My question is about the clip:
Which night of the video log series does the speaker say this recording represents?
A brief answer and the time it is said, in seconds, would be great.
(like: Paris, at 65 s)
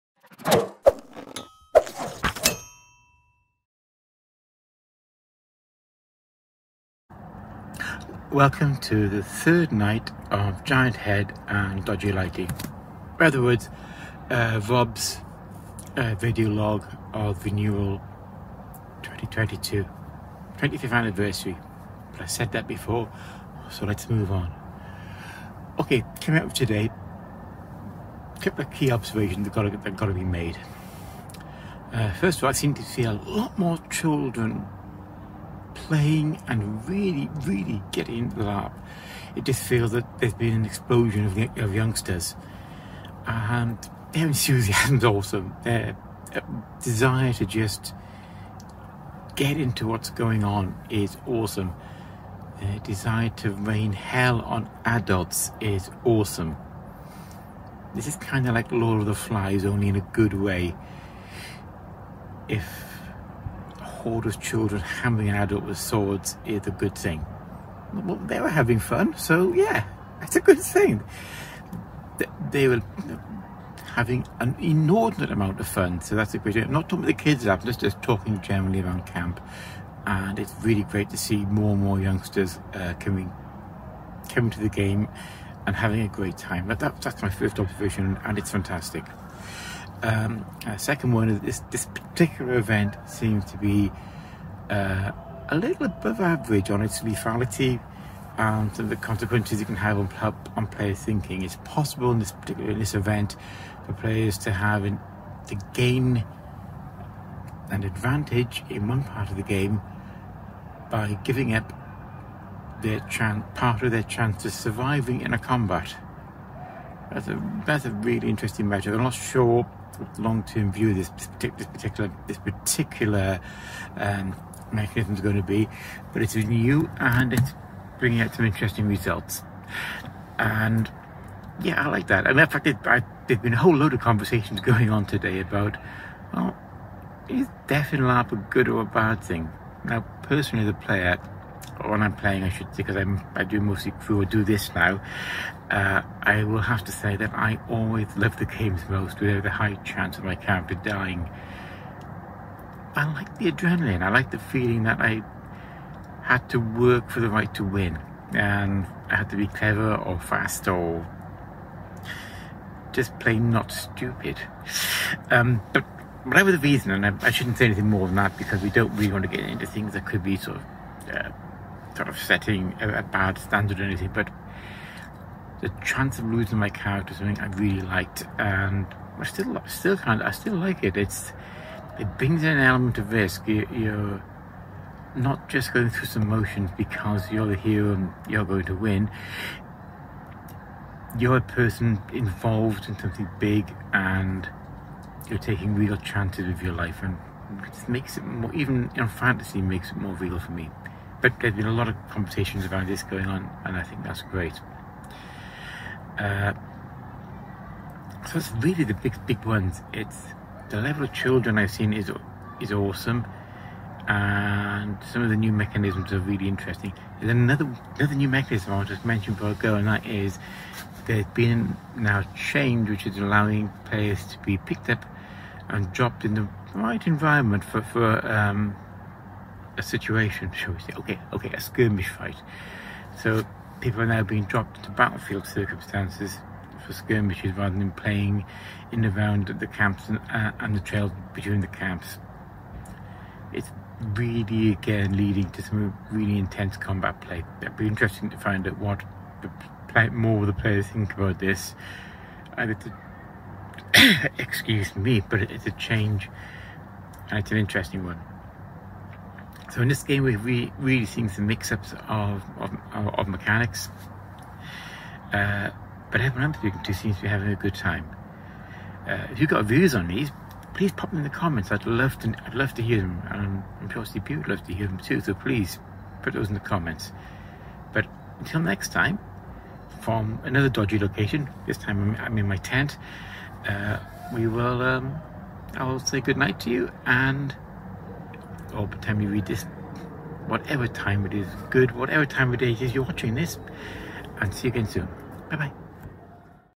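third, at 9 s.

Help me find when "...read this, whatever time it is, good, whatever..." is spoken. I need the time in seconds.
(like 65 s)
289 s.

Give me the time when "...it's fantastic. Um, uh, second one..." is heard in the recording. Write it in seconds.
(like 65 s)
88 s.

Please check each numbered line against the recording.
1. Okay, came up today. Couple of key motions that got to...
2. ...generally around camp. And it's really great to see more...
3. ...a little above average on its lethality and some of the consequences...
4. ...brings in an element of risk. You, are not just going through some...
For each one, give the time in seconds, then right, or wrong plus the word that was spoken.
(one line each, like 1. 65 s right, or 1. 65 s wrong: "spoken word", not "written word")
1. 25 s wrong: "observations", not "motions"
2. 78 s right
3. 95 s right
4. 182 s right.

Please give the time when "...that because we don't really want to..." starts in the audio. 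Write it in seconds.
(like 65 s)
168 s.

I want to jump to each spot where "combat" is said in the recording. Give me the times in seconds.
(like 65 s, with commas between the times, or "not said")
115 s, 246 s.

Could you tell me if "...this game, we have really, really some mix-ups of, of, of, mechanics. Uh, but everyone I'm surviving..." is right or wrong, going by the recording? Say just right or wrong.
wrong.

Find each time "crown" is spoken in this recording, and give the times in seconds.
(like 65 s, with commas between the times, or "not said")
not said.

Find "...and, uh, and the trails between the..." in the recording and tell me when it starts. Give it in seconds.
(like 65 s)
240 s.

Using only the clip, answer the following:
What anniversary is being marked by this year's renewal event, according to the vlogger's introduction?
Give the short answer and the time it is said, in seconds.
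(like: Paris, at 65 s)
25th, at 20 s.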